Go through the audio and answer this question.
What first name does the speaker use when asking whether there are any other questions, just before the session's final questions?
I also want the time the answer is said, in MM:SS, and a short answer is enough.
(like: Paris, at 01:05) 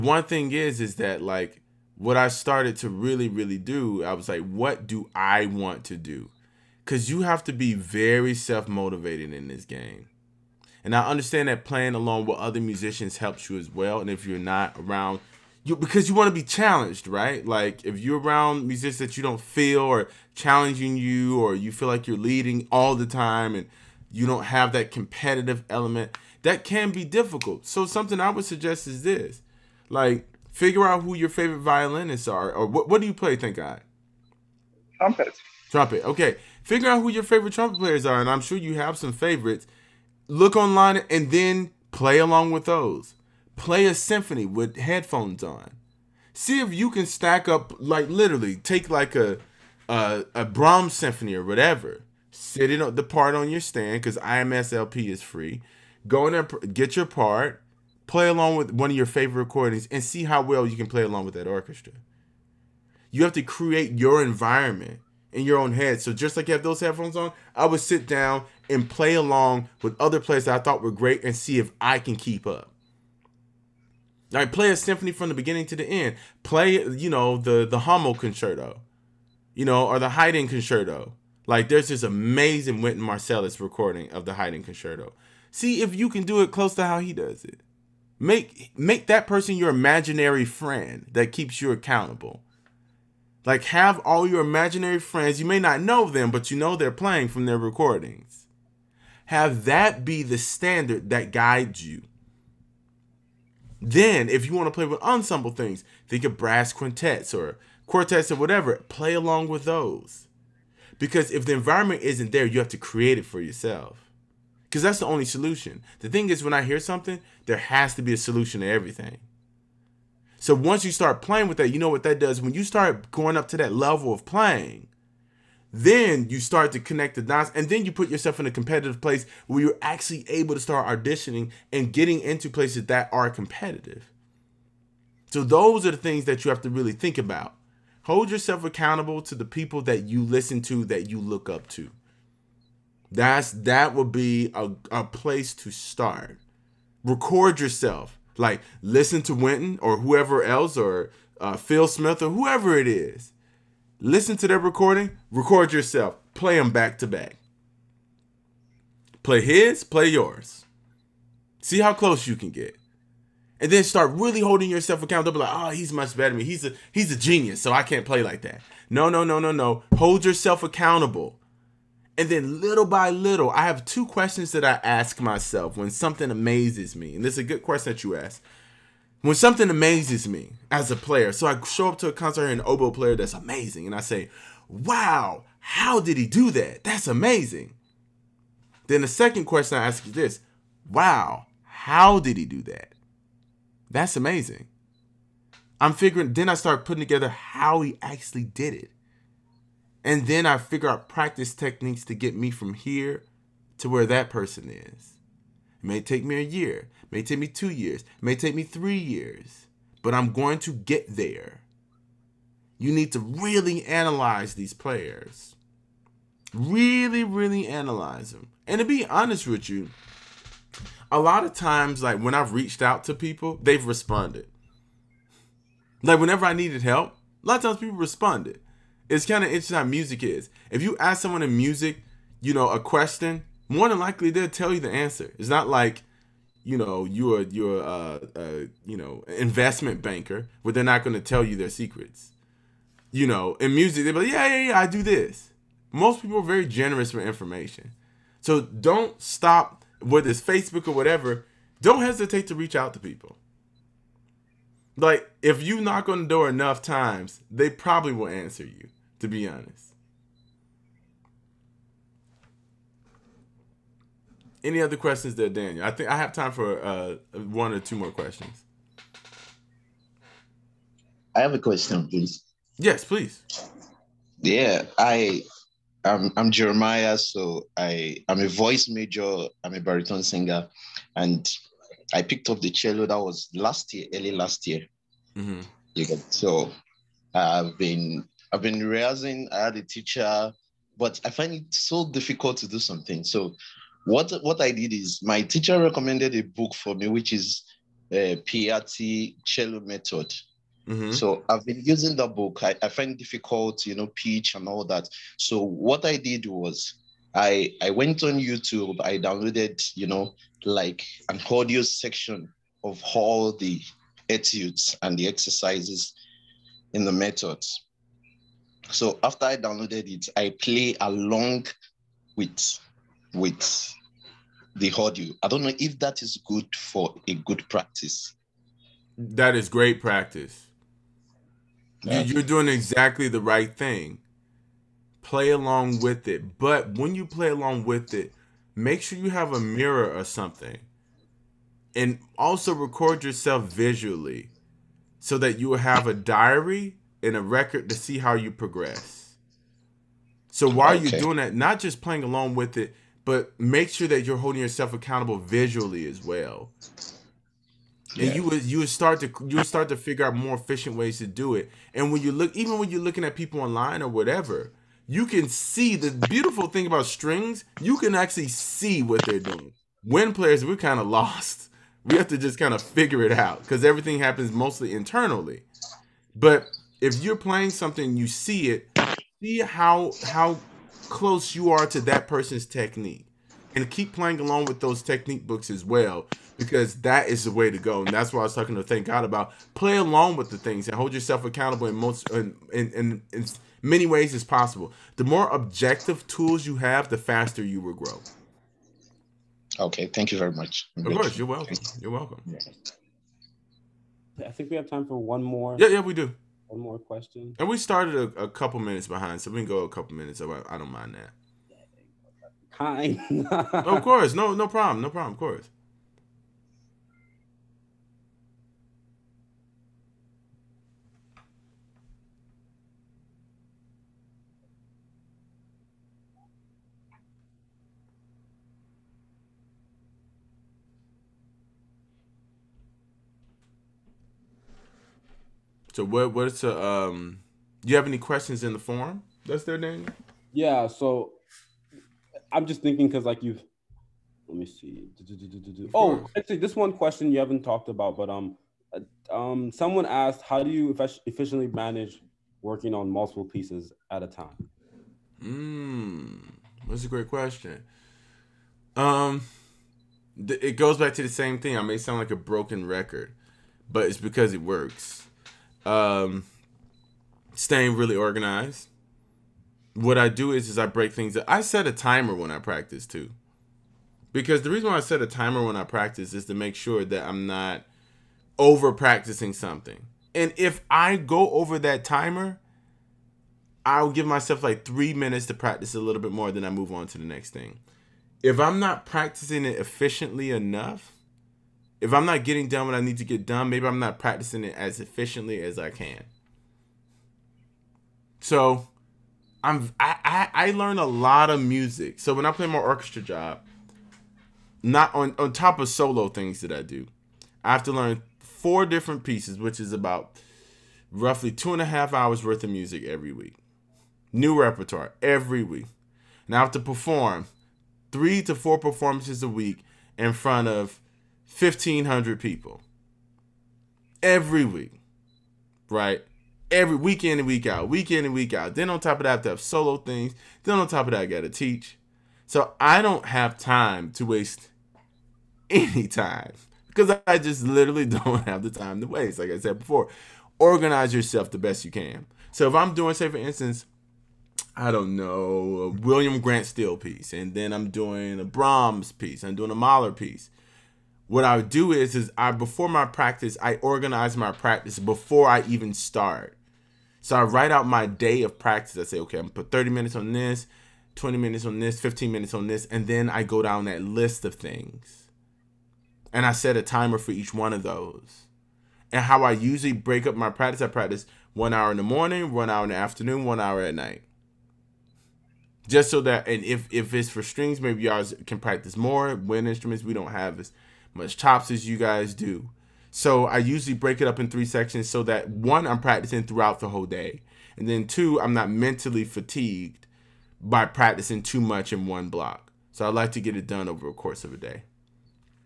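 Daniel, at 04:25.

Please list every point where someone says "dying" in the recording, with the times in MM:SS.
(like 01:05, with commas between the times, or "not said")
not said.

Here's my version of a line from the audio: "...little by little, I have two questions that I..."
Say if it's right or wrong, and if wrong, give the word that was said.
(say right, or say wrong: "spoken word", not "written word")
right.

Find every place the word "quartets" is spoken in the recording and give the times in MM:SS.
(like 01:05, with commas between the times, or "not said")
01:47.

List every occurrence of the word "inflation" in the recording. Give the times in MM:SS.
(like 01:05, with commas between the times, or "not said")
not said.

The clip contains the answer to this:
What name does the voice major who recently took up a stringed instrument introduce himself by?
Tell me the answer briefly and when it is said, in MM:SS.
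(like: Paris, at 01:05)
Jeremiah, at 04:36.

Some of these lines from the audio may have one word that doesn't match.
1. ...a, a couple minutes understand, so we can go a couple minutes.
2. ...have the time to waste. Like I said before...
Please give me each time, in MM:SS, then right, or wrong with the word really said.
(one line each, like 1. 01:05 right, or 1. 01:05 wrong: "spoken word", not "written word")
1. 06:48 wrong: "behind", not "understand"
2. 08:58 right.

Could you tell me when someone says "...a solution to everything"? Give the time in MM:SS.
01:58.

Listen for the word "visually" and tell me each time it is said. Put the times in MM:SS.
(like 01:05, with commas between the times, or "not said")
05:43, 05:55.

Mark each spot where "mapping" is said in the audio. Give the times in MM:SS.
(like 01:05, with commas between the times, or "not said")
not said.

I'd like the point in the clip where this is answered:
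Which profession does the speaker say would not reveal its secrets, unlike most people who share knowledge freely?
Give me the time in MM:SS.
03:59.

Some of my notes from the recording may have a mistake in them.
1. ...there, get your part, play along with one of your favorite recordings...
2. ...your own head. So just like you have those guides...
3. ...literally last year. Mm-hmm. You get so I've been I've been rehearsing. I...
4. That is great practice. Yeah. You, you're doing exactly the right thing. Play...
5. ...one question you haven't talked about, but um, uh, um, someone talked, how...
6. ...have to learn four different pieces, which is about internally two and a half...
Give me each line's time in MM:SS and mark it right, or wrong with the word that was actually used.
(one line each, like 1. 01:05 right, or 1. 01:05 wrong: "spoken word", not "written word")
1. 00:56 right
2. 01:05 wrong: "headphones", not "guides"
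3. 04:44 wrong: "early", not "literally"
4. 05:29 right
5. 07:26 wrong: "asked", not "talked"
6. 08:27 wrong: "roughly", not "internally".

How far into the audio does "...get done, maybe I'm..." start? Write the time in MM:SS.
08:13.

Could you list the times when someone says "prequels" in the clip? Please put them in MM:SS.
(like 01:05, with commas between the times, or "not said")
not said.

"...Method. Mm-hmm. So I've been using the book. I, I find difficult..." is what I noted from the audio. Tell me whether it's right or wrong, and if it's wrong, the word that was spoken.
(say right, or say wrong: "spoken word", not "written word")
right.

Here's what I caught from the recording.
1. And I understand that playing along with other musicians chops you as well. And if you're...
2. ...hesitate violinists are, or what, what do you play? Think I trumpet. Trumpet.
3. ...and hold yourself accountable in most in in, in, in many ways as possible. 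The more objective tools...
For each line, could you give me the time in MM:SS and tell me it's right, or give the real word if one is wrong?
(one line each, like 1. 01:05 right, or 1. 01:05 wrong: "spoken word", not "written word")
1. 00:10 wrong: "helps", not "chops"
2. 00:31 wrong: "favorite", not "hesitate"
3. 06:30 right.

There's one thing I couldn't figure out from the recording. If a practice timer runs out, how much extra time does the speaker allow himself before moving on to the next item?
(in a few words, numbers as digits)
3 minutes.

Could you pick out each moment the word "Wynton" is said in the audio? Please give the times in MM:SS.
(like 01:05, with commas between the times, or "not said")
01:22, 02:29.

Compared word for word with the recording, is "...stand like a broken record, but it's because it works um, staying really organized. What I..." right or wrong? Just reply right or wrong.
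wrong.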